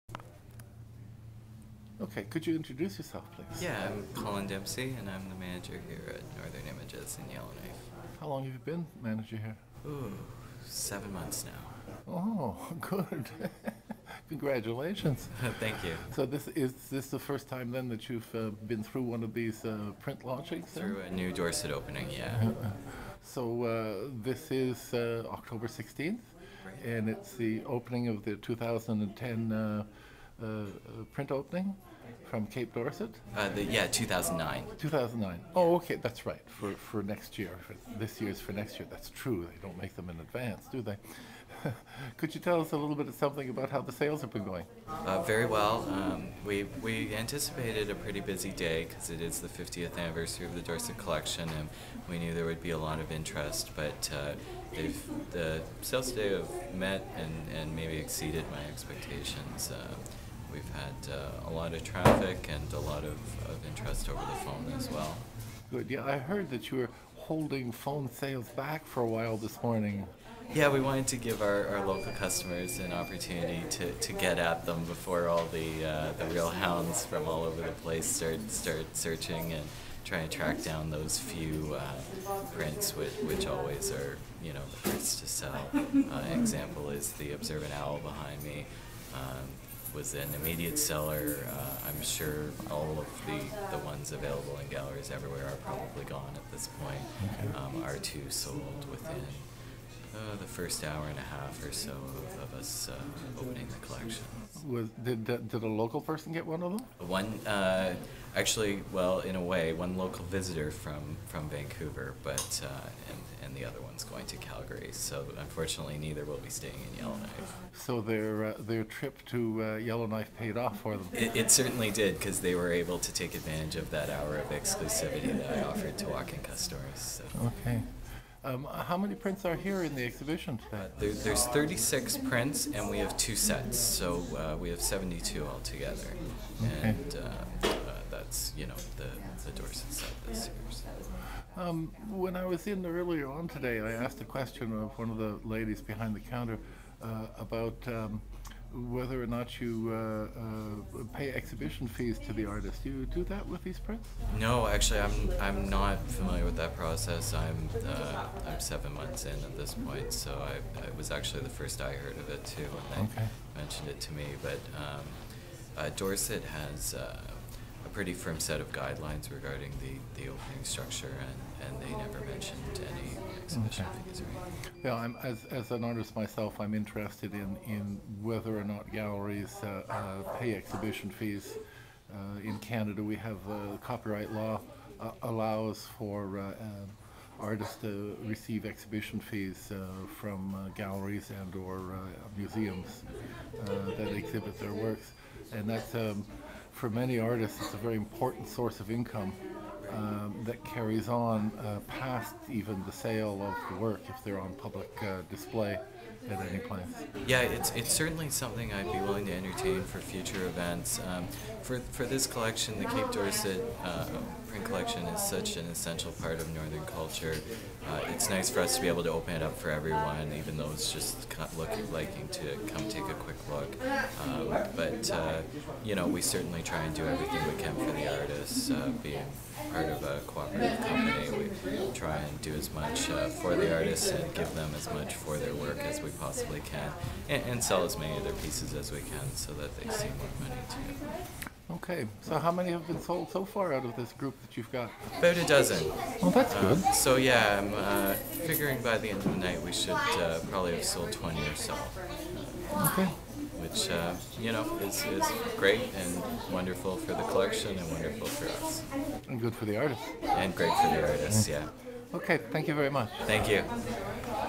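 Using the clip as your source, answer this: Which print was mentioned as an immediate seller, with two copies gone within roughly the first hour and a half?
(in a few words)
The Observant Owl.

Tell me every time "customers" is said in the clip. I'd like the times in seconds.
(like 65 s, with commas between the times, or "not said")
72 s, 126 s.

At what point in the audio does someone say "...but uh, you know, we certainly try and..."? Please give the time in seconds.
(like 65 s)
225 s.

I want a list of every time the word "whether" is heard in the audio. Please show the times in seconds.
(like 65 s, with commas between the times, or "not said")
148 s, 178 s.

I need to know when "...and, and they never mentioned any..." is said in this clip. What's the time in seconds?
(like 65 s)
171 s.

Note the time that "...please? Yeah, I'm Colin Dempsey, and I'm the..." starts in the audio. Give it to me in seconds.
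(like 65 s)
3 s.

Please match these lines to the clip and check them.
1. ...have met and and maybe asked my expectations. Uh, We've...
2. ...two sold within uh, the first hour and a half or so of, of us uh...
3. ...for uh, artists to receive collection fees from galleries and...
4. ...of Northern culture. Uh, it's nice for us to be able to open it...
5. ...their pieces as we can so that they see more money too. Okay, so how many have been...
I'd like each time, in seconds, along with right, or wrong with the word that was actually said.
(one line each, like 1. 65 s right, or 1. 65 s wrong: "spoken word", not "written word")
1. 56 s wrong: "exceeded", not "asked"
2. 98 s right
3. 185 s wrong: "exhibition", not "collection"
4. 216 s right
5. 238 s right.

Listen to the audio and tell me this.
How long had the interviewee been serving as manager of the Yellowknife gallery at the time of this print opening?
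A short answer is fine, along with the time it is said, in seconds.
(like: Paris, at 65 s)
7 months, at 10 s.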